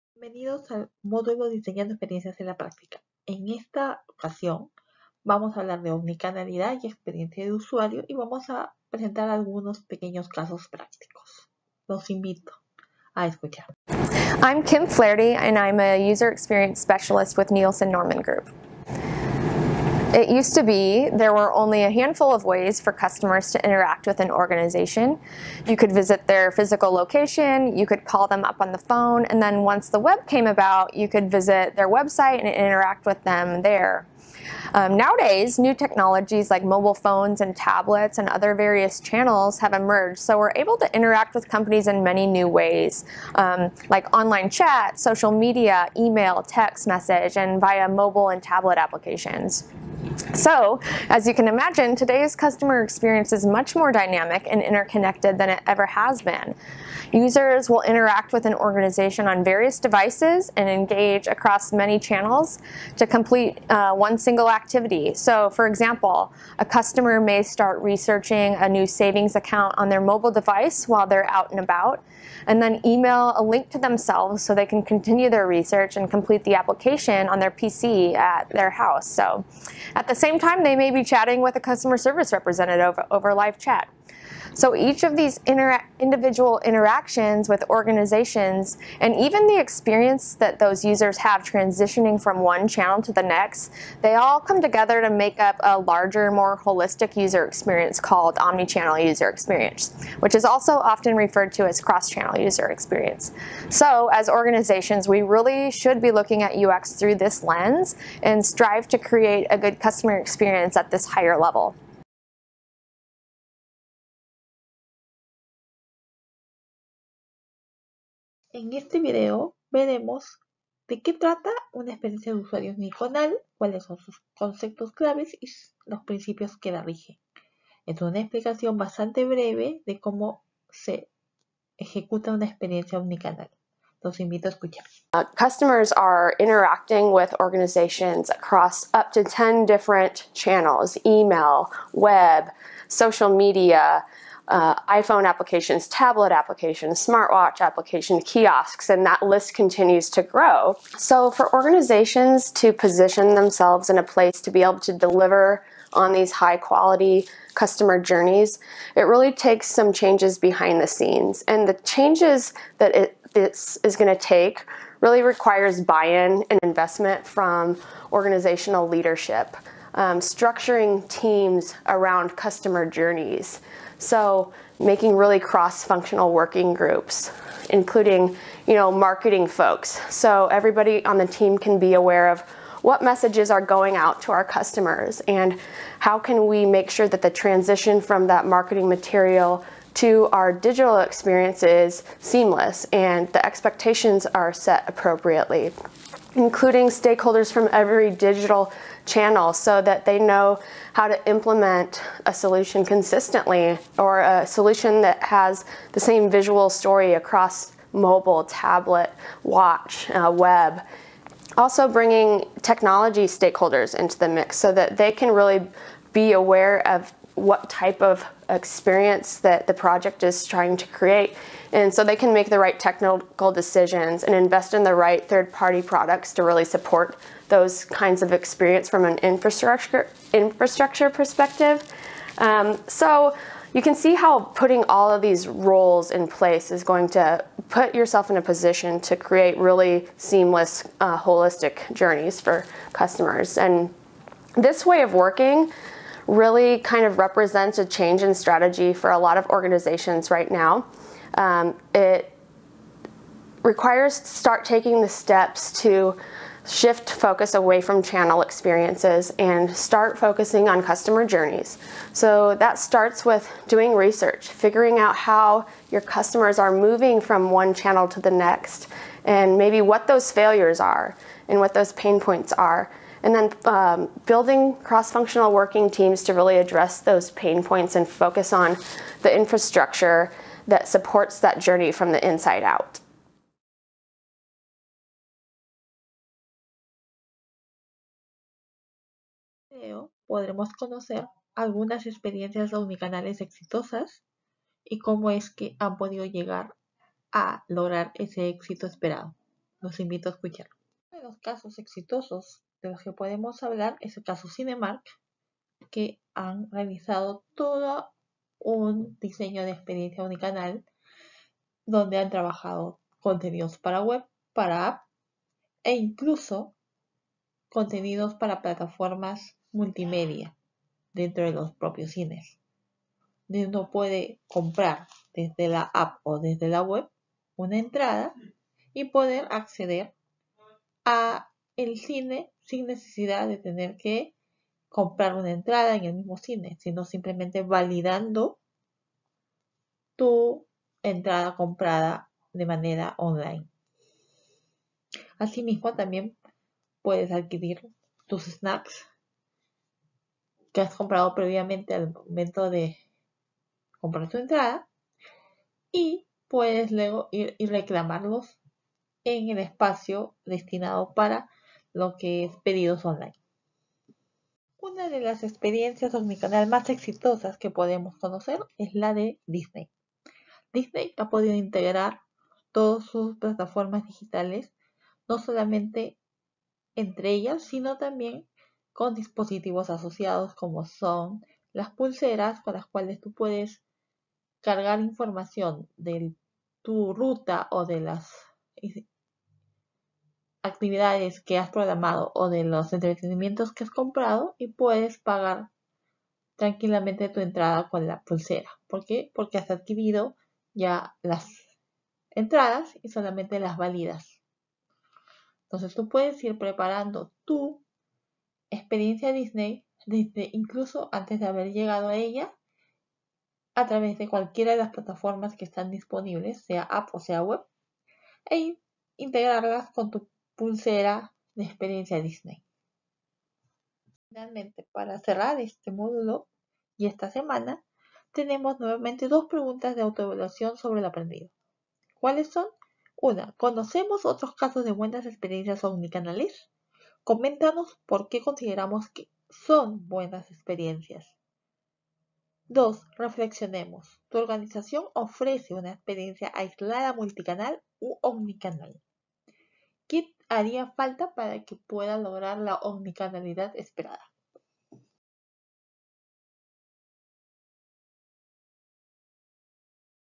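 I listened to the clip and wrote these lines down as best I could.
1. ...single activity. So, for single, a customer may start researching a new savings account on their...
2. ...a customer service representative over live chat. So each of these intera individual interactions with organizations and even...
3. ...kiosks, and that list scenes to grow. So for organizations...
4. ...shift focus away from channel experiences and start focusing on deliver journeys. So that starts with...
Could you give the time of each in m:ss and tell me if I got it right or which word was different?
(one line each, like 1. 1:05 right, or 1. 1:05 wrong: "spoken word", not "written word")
1. 1:04 wrong: "example", not "single"
2. 1:21 right
3. 2:28 wrong: "continues", not "scenes"
4. 4:16 wrong: "customer", not "deliver".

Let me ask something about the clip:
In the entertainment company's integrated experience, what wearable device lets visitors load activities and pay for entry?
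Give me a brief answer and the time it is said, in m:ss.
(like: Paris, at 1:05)
pulseras, at 6:21.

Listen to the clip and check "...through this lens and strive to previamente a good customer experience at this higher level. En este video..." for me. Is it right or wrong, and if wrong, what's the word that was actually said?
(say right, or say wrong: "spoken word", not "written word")
wrong: "create", not "previamente".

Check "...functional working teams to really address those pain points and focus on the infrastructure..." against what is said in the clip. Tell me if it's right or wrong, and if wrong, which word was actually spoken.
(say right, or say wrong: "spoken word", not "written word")
right.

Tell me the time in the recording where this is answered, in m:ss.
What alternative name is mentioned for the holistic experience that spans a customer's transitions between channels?
1:41.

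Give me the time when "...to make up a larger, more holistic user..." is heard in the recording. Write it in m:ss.
1:35.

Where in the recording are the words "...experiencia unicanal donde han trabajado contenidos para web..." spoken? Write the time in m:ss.
5:09.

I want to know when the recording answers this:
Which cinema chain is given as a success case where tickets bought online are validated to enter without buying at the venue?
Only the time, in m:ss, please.
5:04.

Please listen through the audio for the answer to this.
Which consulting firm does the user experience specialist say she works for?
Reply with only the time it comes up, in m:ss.
0:17.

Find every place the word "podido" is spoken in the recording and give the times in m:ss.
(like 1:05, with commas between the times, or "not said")
4:55, 6:11.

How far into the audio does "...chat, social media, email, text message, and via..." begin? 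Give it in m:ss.
0:44.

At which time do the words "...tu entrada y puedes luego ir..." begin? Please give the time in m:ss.
5:54.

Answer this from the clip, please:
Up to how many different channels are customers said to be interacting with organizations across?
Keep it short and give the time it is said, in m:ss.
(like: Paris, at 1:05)
10, at 2:19.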